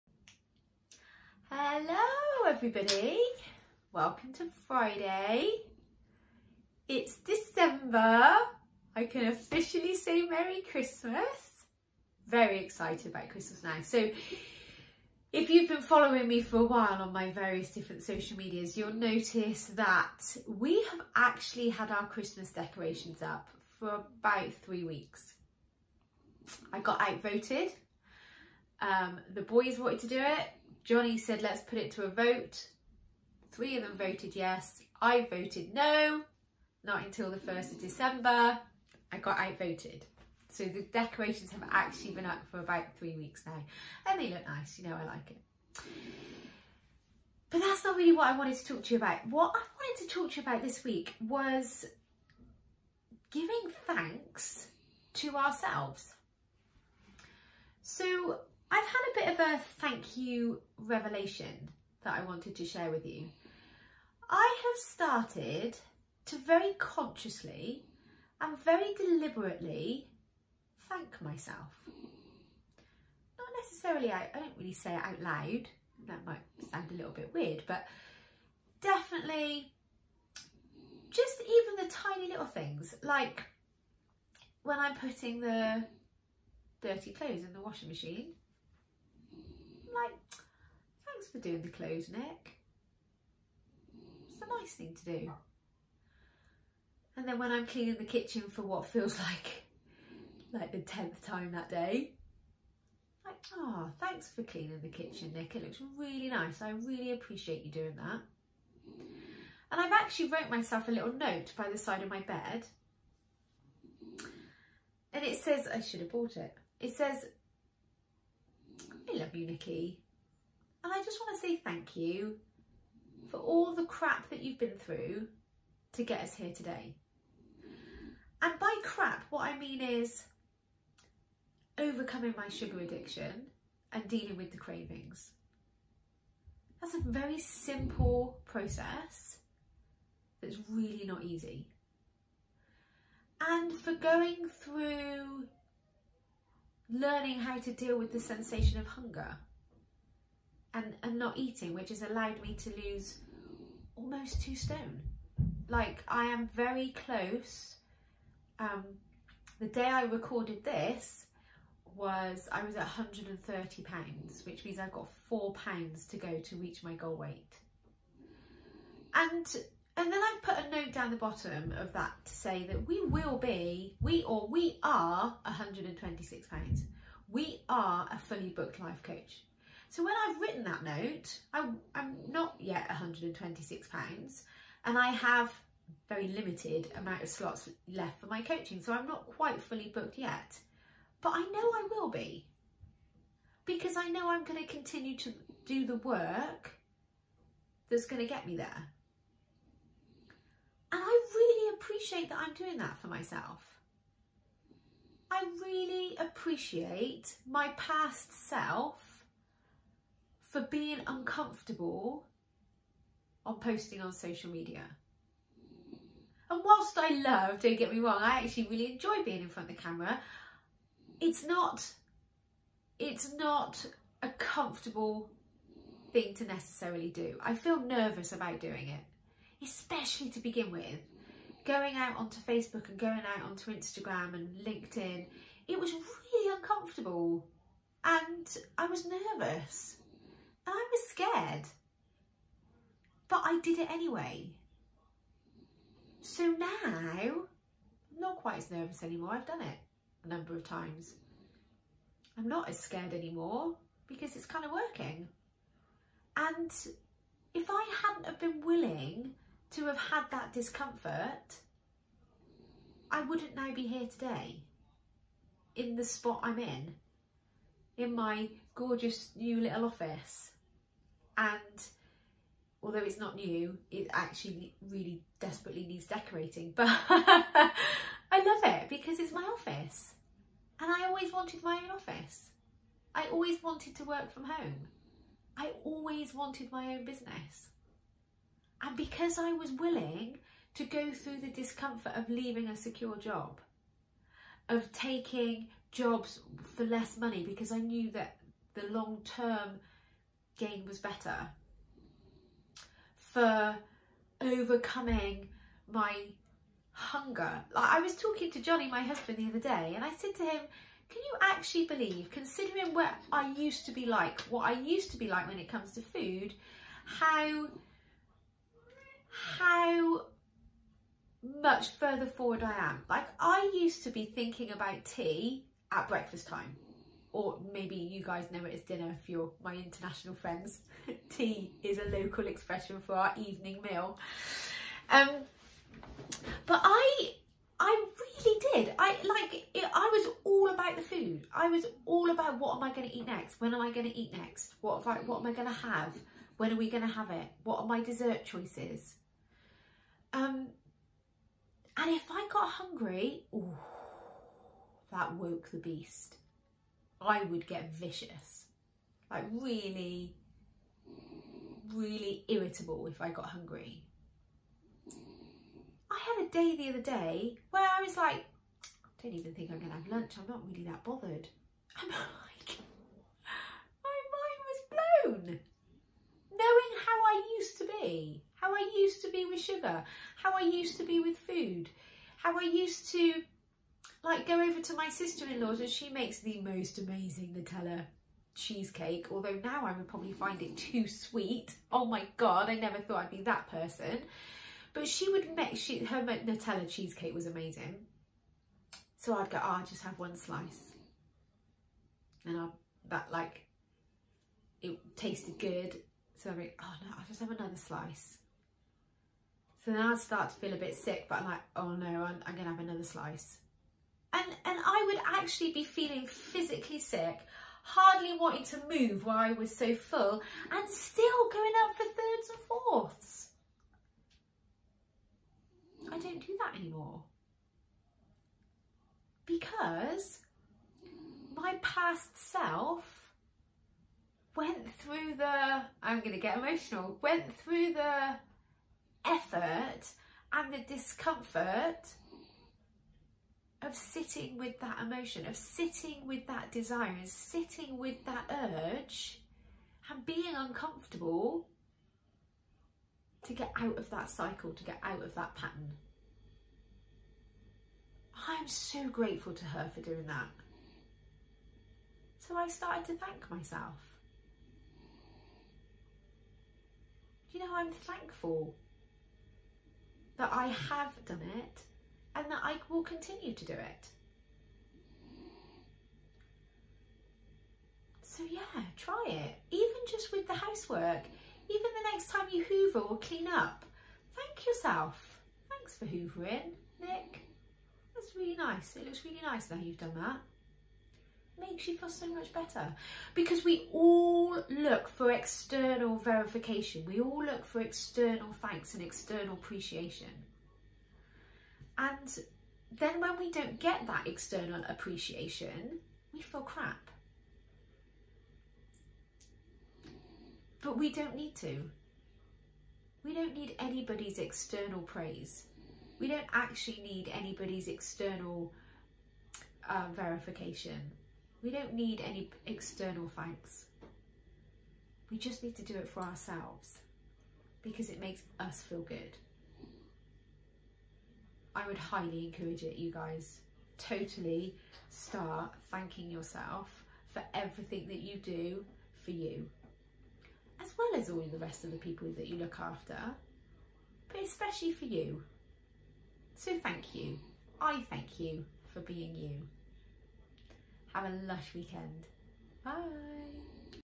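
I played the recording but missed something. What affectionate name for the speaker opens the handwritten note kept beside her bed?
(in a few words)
Nicky.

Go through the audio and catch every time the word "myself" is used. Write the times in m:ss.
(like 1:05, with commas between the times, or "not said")
1:11, 1:50, 3:23, 7:43.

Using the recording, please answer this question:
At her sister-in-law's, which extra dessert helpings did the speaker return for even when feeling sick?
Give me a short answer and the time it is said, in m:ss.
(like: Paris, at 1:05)
thirds and fourths, at 7:02.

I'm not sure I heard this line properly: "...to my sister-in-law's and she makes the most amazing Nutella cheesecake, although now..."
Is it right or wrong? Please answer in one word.
right.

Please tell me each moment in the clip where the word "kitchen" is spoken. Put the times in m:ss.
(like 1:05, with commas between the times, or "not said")
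1:38, 1:44.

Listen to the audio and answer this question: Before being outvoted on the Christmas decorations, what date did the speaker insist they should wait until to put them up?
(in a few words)
1st of December.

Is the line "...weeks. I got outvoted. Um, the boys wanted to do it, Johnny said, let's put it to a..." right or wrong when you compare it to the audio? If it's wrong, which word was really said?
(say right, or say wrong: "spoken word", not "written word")
right.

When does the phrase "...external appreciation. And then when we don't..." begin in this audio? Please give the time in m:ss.
8:19.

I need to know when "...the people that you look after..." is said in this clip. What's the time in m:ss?
9:01.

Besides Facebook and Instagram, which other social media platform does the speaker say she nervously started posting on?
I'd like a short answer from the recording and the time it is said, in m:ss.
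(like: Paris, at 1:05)
LinkedIn, at 3:54.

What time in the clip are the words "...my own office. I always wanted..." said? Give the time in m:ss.
4:41.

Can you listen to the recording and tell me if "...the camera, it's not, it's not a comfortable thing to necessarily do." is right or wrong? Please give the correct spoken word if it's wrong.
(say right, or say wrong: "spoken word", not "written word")
right.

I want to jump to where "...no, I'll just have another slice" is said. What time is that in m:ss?
6:47.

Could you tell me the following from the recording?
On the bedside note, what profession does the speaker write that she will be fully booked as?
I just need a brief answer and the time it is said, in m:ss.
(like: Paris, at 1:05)
life coach, at 2:58.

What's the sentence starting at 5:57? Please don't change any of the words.
I would get vicious, like really, really irritable if I got hungry.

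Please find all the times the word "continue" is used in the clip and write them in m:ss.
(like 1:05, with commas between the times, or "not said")
3:14, 7:53.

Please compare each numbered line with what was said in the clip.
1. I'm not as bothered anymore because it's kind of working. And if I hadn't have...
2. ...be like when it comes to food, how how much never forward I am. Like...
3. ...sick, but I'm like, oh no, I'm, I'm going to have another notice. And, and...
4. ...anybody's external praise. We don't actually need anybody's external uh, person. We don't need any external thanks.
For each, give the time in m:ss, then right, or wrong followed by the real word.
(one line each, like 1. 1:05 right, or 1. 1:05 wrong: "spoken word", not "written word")
1. 4:12 wrong: "scared", not "bothered"
2. 5:15 wrong: "further", not "never"
3. 6:50 wrong: "slice", not "notice"
4. 8:33 wrong: "verification", not "person".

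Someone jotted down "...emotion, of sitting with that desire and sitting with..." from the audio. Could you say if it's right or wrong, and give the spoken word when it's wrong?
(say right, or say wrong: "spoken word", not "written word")
right.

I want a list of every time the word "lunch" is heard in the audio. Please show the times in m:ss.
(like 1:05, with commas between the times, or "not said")
6:10.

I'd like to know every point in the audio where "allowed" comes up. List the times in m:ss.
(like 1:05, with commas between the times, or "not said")
2:32.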